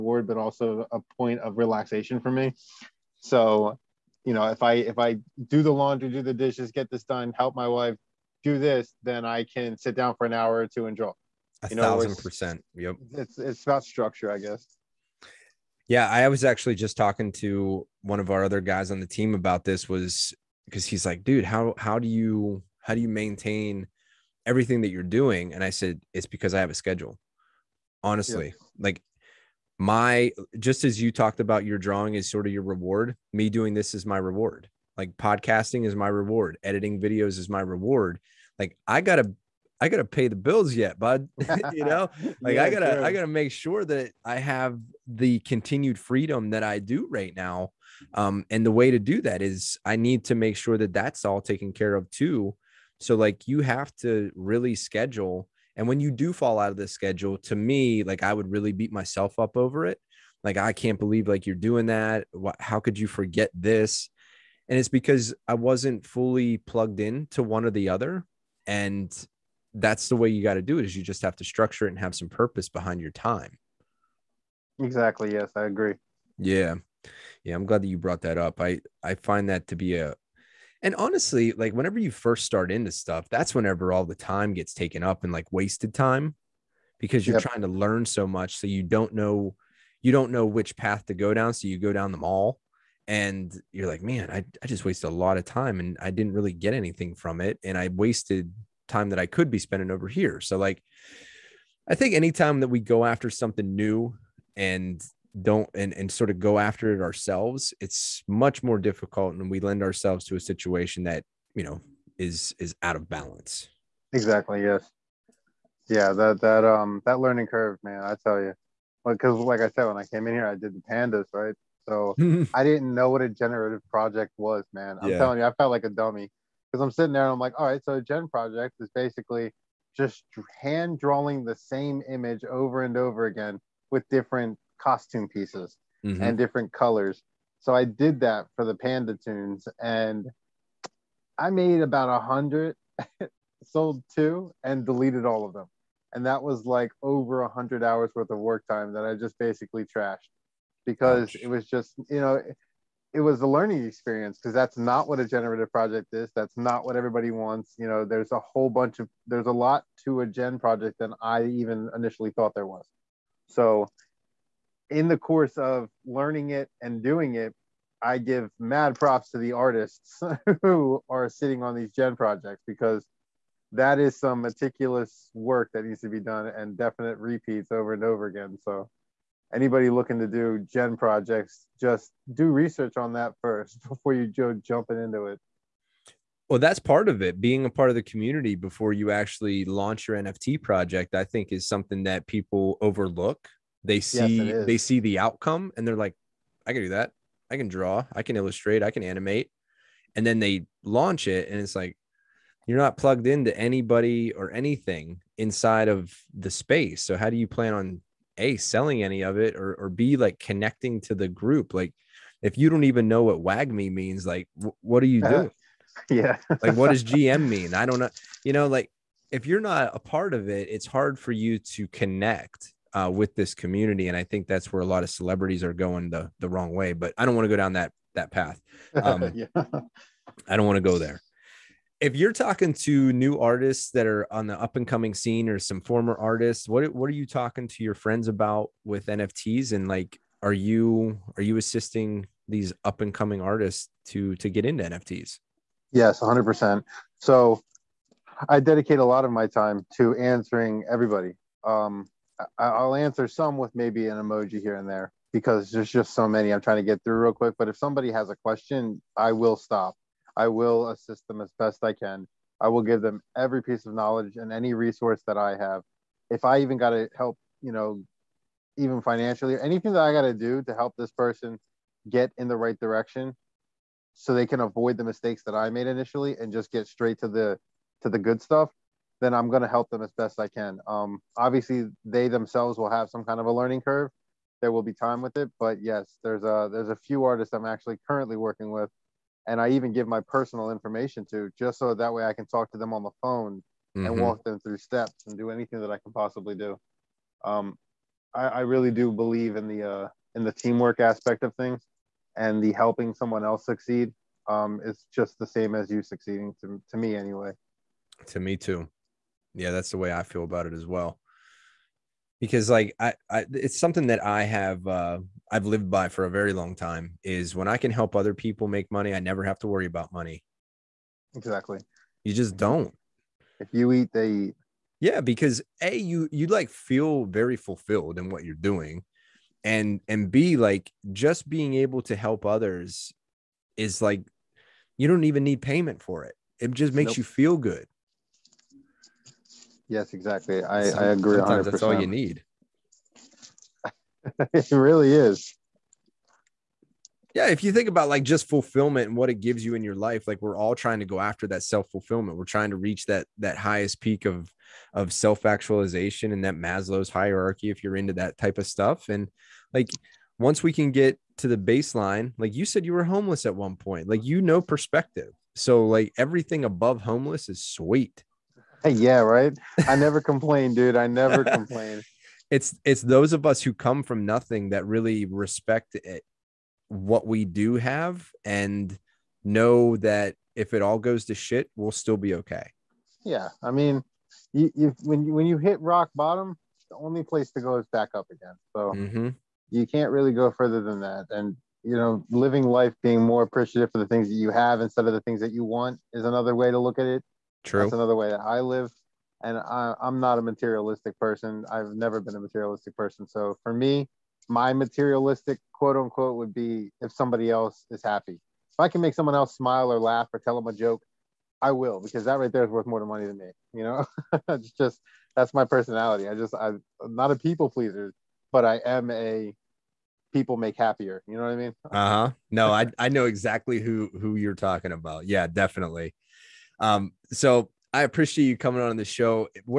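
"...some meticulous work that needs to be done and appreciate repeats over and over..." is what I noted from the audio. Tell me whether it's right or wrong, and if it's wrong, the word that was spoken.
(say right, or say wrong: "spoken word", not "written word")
wrong: "definite", not "appreciate".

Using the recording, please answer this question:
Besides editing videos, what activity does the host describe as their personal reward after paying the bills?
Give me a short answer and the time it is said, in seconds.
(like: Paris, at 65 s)
podcasting, at 35 s.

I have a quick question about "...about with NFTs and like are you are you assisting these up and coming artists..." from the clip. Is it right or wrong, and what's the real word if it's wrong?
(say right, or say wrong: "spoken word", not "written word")
right.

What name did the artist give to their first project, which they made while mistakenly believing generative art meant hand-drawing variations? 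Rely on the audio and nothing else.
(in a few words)
Panda Toons.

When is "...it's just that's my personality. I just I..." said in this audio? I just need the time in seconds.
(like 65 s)
414 s.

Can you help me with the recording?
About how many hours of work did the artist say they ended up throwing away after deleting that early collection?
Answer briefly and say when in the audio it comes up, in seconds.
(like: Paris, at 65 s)
100, at 147 s.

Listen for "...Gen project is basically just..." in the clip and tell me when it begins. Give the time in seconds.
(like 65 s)
128 s.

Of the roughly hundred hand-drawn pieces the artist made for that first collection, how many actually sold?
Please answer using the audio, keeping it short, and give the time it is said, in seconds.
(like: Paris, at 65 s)
2, at 143 s.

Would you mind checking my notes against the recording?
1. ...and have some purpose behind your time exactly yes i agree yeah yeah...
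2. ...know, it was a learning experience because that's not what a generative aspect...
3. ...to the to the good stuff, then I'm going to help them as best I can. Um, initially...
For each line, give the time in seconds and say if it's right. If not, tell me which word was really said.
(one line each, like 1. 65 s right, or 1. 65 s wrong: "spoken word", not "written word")
1. 71 s right
2. 152 s wrong: "project", not "aspect"
3. 277 s wrong: "obviously", not "initially".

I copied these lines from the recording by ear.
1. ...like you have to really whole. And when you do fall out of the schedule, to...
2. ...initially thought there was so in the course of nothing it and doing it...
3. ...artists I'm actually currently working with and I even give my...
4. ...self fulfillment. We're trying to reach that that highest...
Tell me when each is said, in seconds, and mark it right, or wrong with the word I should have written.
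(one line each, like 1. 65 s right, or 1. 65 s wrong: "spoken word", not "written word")
1. 53 s wrong: "schedule", not "whole"
2. 161 s wrong: "learning", not "nothing"
3. 287 s right
4. 351 s right.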